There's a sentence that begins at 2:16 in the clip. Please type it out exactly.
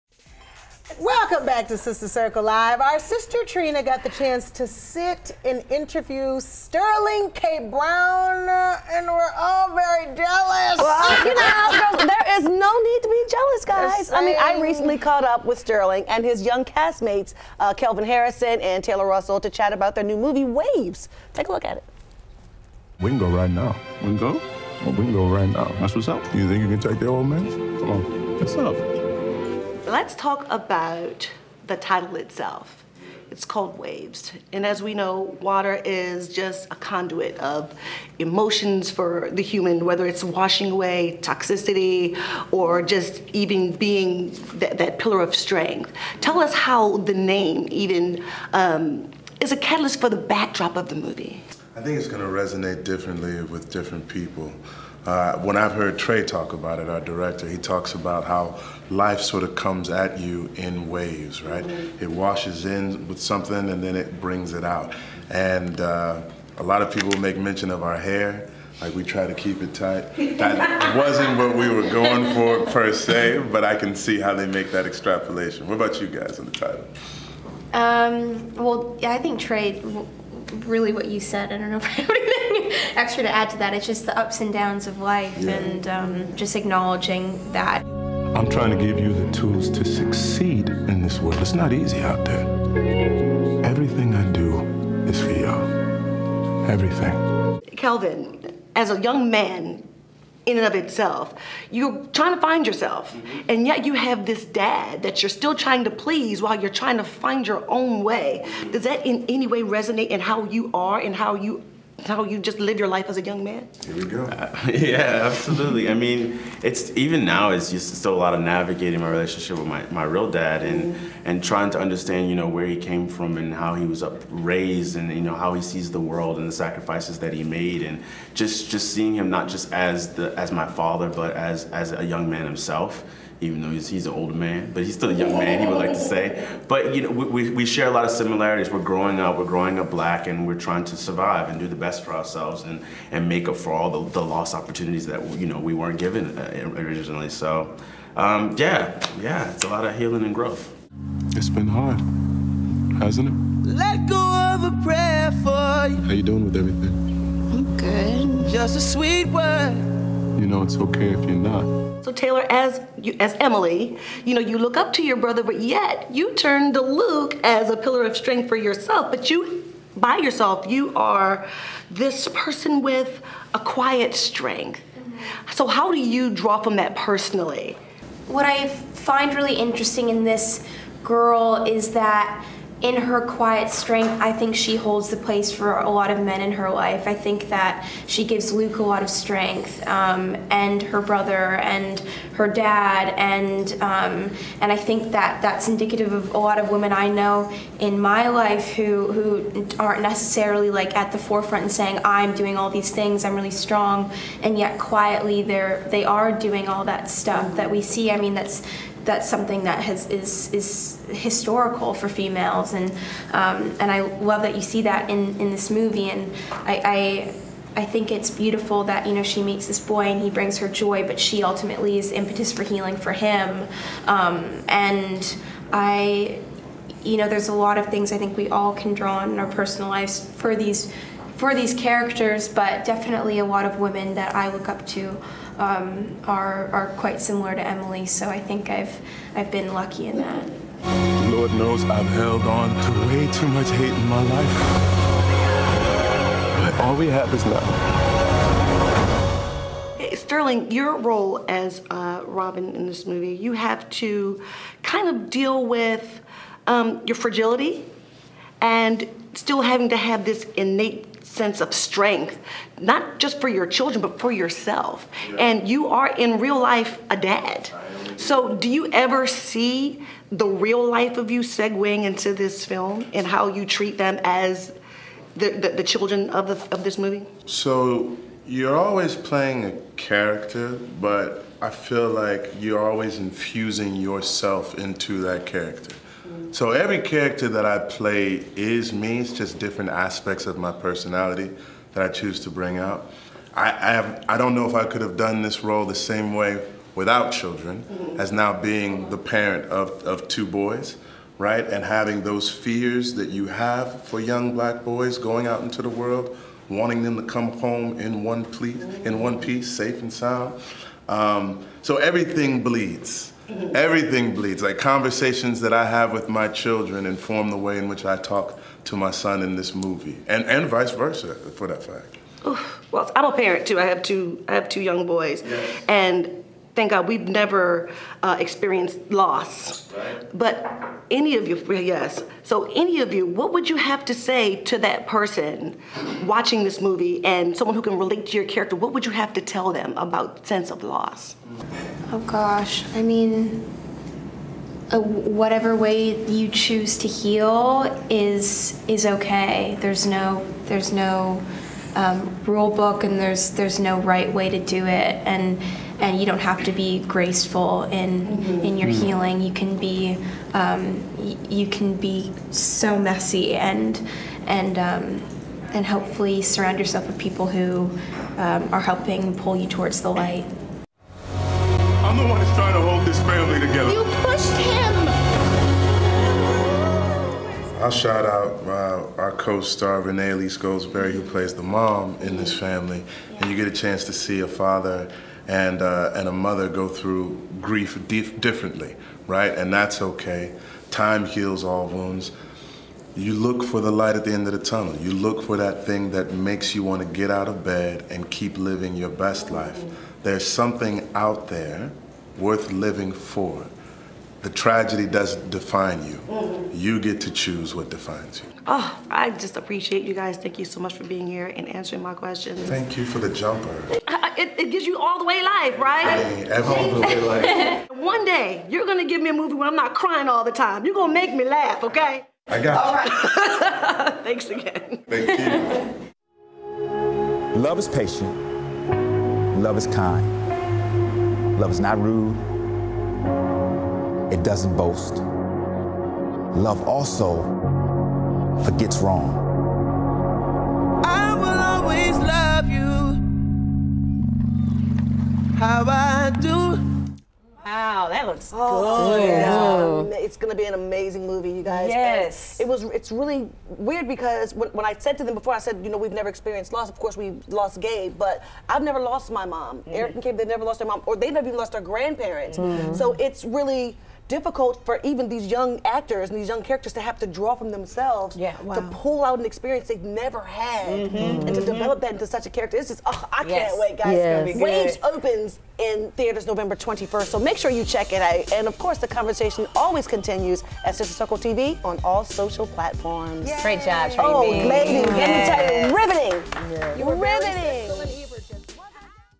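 But you know, we, we share a lot of similarities.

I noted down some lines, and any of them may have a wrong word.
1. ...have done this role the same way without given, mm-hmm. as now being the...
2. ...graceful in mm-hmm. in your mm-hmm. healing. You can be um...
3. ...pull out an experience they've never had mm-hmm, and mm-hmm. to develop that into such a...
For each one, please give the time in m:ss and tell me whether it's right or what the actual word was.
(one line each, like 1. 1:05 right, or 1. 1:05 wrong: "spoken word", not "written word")
1. 4:54 wrong: "children", not "given"
2. 5:56 right
3. 7:49 right.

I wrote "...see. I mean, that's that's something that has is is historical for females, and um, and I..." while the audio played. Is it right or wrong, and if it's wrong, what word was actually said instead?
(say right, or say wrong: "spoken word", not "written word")
right.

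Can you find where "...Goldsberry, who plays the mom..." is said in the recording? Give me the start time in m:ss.
6:20.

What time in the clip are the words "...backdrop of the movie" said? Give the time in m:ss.
0:50.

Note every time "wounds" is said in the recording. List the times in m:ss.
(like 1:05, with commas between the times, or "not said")
6:31.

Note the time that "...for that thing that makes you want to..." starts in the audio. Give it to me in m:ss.
6:35.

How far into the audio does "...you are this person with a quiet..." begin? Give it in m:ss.
2:50.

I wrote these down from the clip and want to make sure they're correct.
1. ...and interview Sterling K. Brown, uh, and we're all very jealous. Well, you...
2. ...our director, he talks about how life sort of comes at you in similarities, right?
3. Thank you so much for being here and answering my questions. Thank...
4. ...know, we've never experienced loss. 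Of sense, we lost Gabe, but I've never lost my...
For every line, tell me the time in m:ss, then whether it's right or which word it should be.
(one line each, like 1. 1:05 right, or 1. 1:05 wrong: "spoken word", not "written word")
1. 0:05 right
2. 0:56 wrong: "waves", not "similarities"
3. 6:50 right
4. 7:35 wrong: "course", not "sense".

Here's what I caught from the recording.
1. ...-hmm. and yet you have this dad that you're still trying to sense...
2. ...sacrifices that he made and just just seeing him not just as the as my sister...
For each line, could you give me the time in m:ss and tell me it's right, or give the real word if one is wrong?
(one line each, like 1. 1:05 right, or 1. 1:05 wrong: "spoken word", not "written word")
1. 1:43 wrong: "please", not "sense"
2. 2:06 wrong: "father", not "sister".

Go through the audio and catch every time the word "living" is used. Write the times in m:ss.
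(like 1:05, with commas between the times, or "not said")
6:38, 6:42.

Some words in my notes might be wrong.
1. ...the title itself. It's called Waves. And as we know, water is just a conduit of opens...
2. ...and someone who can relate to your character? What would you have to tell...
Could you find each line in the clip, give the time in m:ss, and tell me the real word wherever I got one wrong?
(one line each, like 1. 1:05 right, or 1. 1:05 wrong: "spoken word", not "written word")
1. 0:31 wrong: "emotions", not "opens"
2. 5:37 right.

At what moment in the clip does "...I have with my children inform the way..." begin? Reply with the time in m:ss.
5:15.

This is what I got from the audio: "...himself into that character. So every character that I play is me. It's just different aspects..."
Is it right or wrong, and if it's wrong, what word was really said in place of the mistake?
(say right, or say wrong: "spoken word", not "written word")
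wrong: "yourself", not "himself".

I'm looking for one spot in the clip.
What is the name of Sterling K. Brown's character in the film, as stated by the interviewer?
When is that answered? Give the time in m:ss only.
4:12.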